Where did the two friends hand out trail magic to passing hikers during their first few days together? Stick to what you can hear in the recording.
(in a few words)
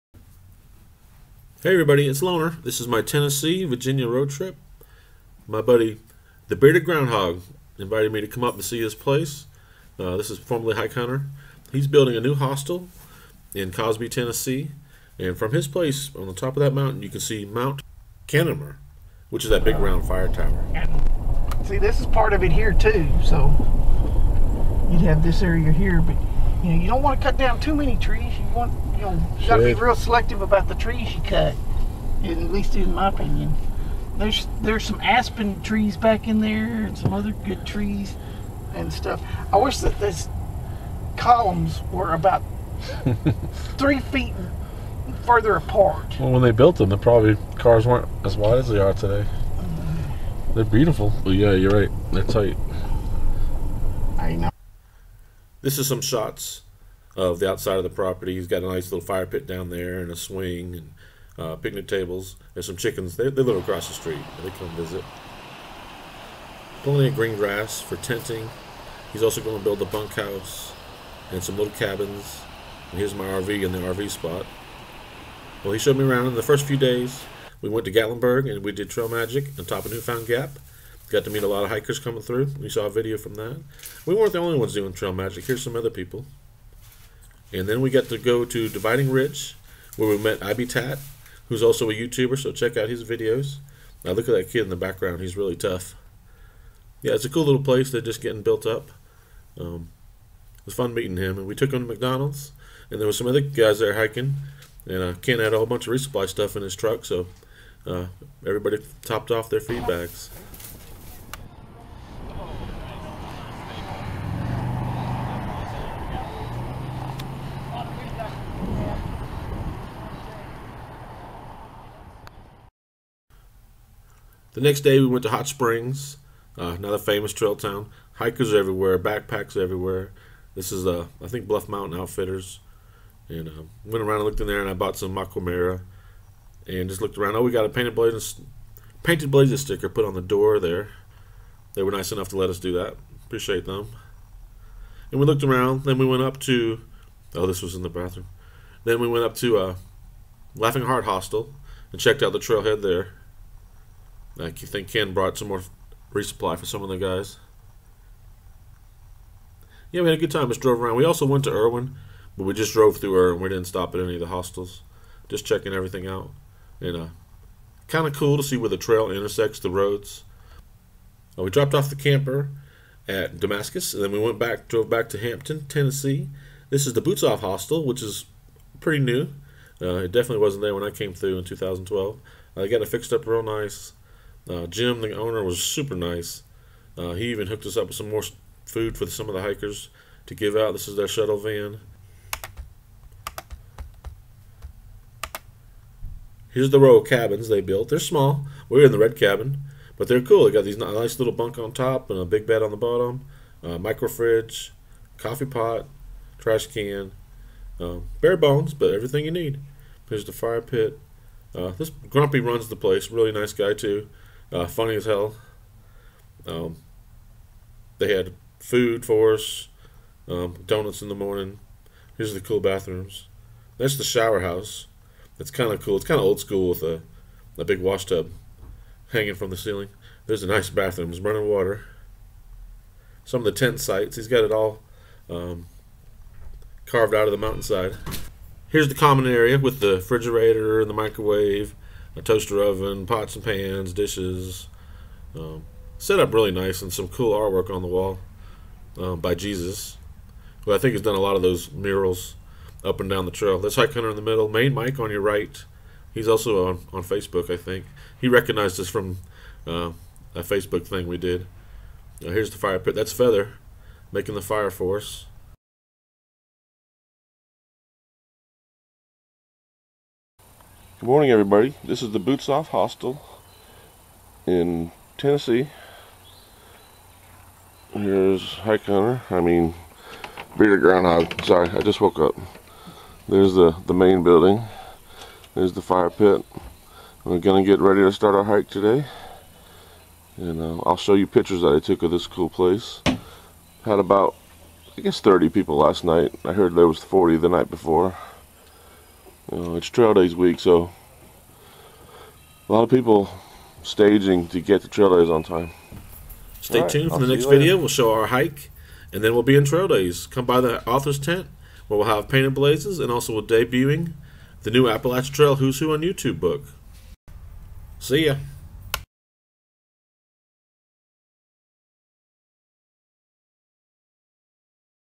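Newfound Gap.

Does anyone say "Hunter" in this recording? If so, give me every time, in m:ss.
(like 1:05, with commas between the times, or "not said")
0:10, 4:13, 4:38.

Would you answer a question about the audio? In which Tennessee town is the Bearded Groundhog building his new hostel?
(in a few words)
Cosby.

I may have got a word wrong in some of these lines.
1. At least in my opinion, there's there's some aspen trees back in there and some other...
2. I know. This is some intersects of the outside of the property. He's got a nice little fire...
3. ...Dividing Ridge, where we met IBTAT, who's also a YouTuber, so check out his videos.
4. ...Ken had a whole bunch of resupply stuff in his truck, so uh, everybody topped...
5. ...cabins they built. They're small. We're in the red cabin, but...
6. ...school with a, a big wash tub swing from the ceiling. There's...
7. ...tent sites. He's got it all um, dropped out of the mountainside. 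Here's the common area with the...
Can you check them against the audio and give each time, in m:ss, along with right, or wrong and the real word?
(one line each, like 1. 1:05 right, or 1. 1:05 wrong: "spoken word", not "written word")
1. 0:32 right
2. 0:54 wrong: "shots", not "intersects"
3. 1:28 right
4. 1:45 right
5. 3:17 right
6. 3:46 wrong: "hanging", not "swing"
7. 3:53 wrong: "carved", not "dropped".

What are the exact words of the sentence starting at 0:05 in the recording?
My buddy, the Bearded Groundhog, invited me to come up and see his place.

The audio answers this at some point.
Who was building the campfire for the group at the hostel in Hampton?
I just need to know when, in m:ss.
4:23.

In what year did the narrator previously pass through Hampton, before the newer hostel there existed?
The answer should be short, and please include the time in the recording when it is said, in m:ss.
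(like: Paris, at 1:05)
2012, at 3:01.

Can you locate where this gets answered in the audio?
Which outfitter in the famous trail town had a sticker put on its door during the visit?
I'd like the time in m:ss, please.
2:11.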